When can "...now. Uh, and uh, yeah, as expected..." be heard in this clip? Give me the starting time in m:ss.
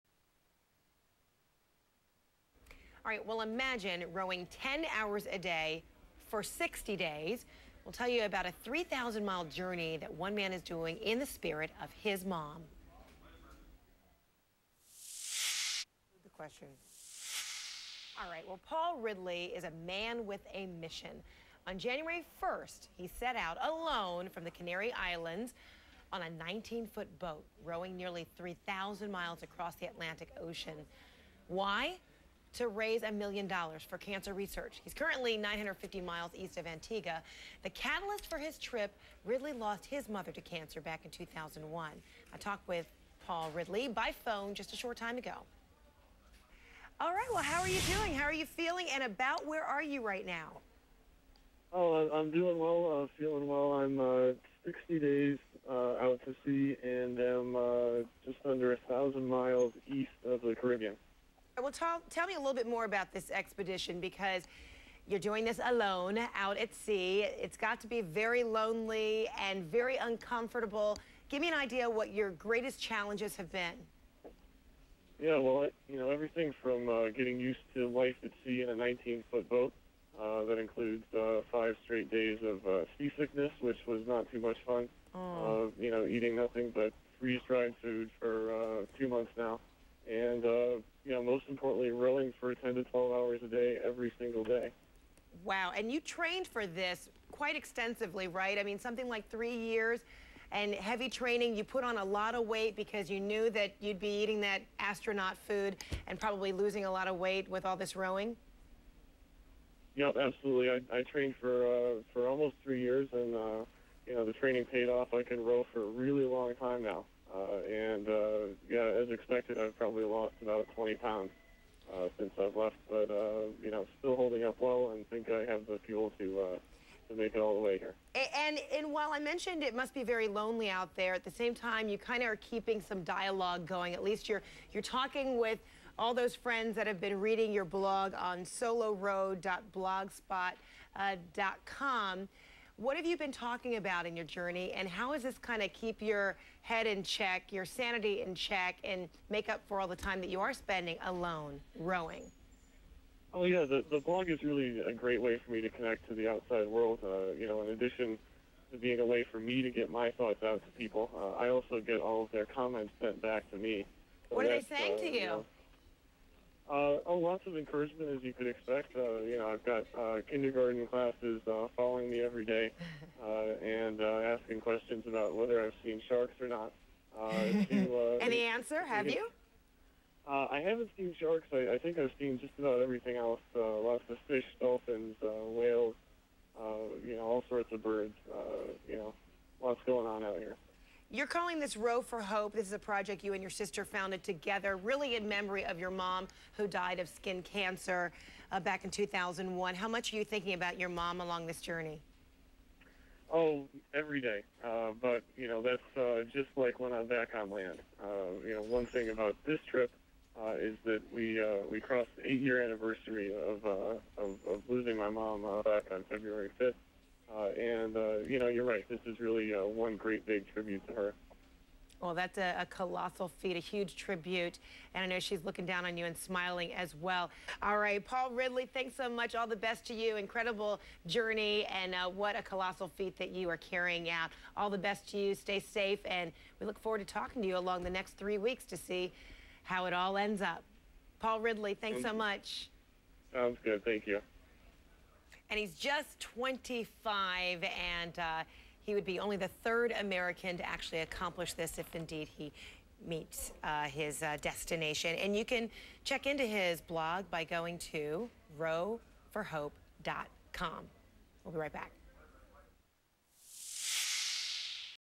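1:56.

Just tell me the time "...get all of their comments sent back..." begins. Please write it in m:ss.
2:41.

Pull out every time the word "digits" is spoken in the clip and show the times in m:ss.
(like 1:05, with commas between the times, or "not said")
not said.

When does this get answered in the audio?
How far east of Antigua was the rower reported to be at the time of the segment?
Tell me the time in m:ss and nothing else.
0:35.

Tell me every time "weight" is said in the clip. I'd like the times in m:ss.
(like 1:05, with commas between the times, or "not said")
1:42, 1:47.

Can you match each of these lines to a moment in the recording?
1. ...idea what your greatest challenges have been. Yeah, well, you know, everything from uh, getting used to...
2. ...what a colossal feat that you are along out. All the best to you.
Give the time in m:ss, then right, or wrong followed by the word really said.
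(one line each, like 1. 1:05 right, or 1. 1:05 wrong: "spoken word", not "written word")
1. 1:11 right
2. 3:52 wrong: "carrying", not "along".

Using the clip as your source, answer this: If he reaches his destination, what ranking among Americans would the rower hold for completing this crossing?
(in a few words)
Third.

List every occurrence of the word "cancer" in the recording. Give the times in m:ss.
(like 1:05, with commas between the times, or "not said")
0:33, 0:40, 3:17.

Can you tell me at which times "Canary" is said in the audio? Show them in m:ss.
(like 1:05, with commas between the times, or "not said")
0:24.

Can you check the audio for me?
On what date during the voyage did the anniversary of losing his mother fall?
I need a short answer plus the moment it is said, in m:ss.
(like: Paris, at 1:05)
February 5th, at 3:36.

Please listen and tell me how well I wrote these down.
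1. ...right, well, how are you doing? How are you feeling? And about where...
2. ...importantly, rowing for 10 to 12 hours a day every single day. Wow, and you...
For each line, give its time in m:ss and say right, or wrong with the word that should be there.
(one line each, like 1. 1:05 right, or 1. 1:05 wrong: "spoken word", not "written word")
1. 0:47 right
2. 1:31 right.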